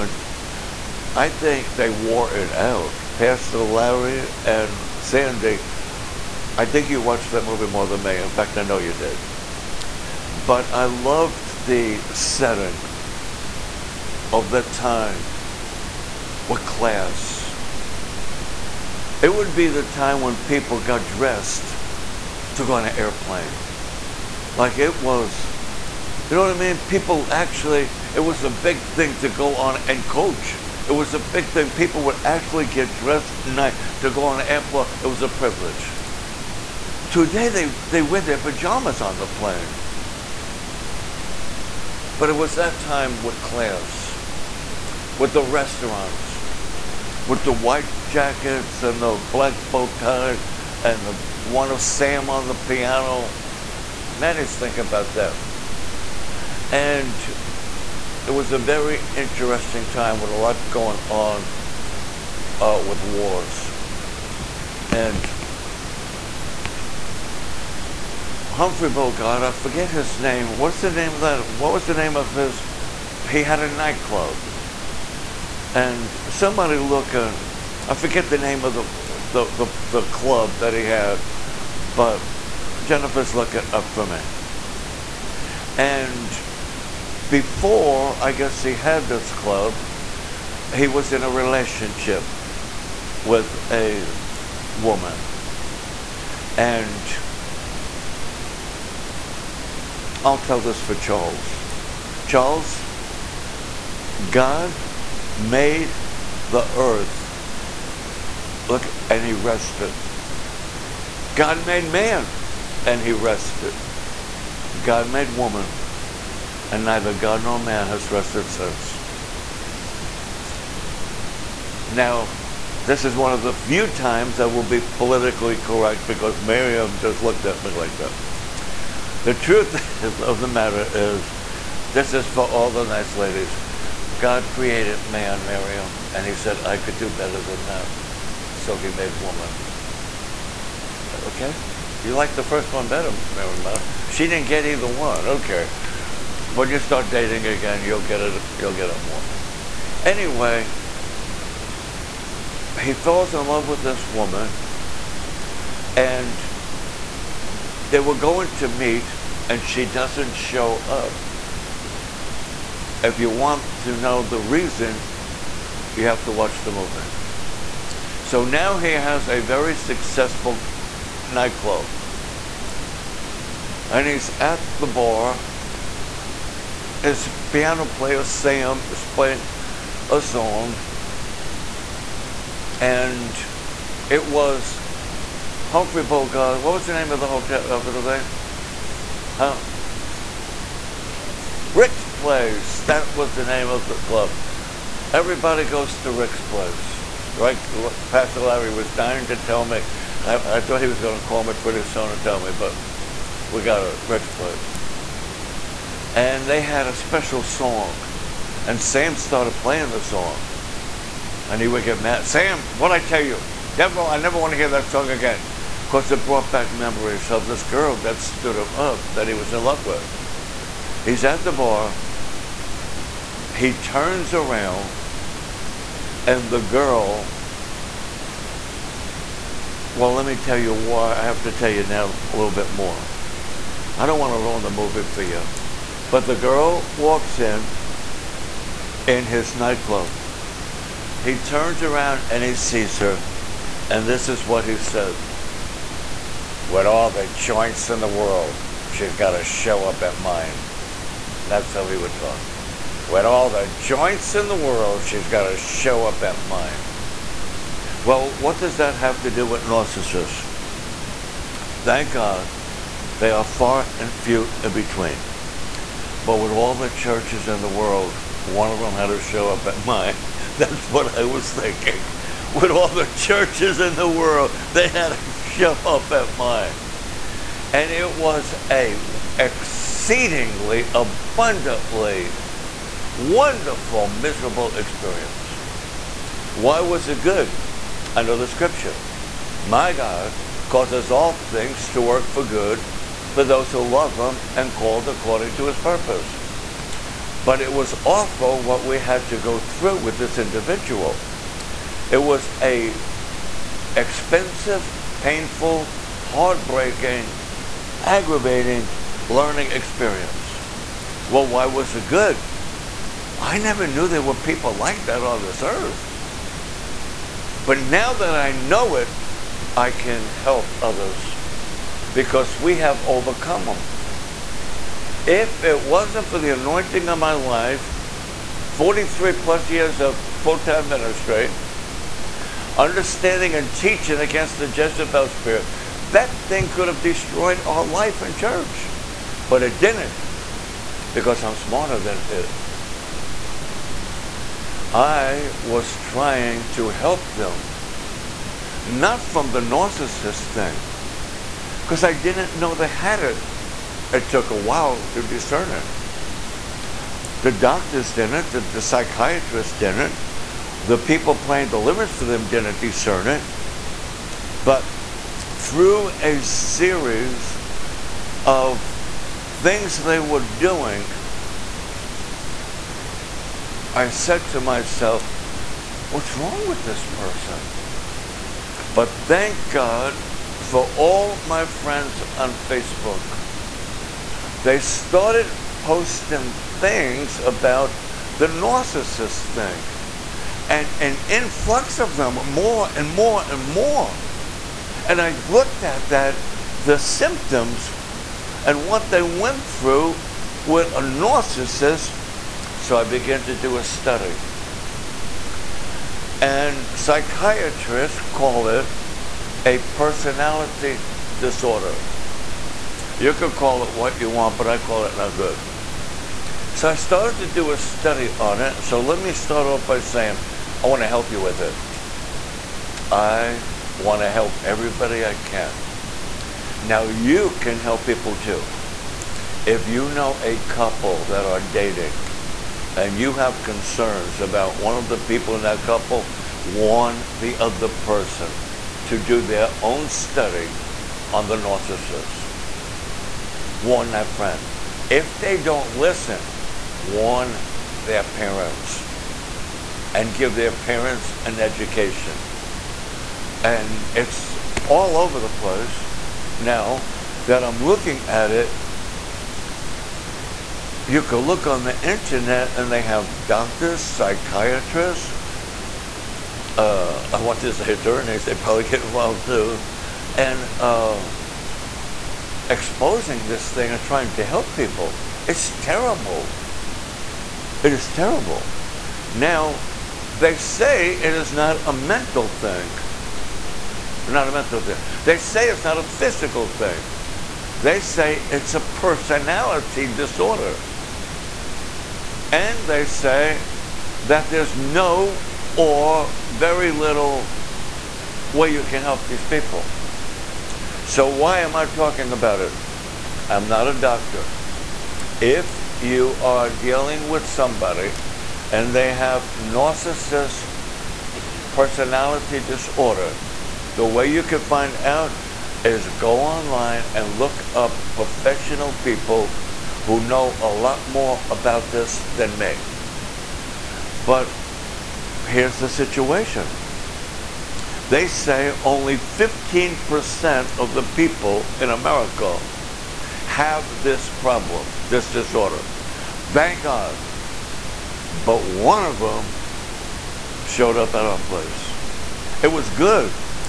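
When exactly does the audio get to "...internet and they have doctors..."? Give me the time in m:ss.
7:42.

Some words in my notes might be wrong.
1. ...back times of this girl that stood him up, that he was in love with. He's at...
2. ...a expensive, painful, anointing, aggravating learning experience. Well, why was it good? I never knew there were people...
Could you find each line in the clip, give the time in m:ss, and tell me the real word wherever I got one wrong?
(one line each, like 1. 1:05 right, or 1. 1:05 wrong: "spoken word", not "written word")
1. 3:36 wrong: "memories", not "times"
2. 5:02 wrong: "heartbreaking", not "anointing".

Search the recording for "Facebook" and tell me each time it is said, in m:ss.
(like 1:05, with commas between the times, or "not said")
6:22.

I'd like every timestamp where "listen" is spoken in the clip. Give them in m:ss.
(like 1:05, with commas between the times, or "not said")
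7:25.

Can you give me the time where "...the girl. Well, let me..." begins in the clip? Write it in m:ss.
3:46.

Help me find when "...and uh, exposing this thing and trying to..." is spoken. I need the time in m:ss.
7:50.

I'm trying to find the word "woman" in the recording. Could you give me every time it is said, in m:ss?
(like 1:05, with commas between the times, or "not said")
1:34, 1:55, 2:19, 2:34.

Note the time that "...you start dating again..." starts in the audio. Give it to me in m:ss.
2:26.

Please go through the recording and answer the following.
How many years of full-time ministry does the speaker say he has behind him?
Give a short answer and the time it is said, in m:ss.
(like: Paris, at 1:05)
43, at 5:28.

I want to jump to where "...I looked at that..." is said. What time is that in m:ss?
6:35.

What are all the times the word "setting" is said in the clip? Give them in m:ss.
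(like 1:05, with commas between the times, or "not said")
0:12.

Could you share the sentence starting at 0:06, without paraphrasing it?
I think you watched that movie more than me.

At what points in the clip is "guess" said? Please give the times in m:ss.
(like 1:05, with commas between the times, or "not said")
1:28.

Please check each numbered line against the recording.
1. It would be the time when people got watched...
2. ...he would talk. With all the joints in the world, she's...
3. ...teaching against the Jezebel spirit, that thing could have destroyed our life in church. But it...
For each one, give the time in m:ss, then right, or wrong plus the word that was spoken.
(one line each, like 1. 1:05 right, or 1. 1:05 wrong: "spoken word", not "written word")
1. 0:19 wrong: "dressed", not "watched"
2. 4:11 right
3. 5:33 right.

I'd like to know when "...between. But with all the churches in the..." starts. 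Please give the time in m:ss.
4:24.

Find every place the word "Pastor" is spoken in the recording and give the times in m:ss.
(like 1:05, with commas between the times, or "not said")
0:03, 3:18.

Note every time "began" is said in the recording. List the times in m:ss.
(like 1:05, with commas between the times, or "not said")
6:43.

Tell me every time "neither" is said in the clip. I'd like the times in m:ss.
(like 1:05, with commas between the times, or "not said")
1:56.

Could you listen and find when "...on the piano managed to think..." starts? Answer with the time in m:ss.
0:52.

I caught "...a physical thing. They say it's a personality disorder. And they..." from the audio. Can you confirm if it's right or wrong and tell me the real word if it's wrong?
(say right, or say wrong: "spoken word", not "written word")
right.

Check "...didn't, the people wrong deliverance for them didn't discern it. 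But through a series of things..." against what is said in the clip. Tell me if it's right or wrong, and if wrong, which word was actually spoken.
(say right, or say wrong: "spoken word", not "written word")
wrong: "playing", not "wrong".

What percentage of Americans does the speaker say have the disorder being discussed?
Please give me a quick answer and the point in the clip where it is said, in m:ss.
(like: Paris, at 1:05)
15%, at 8:49.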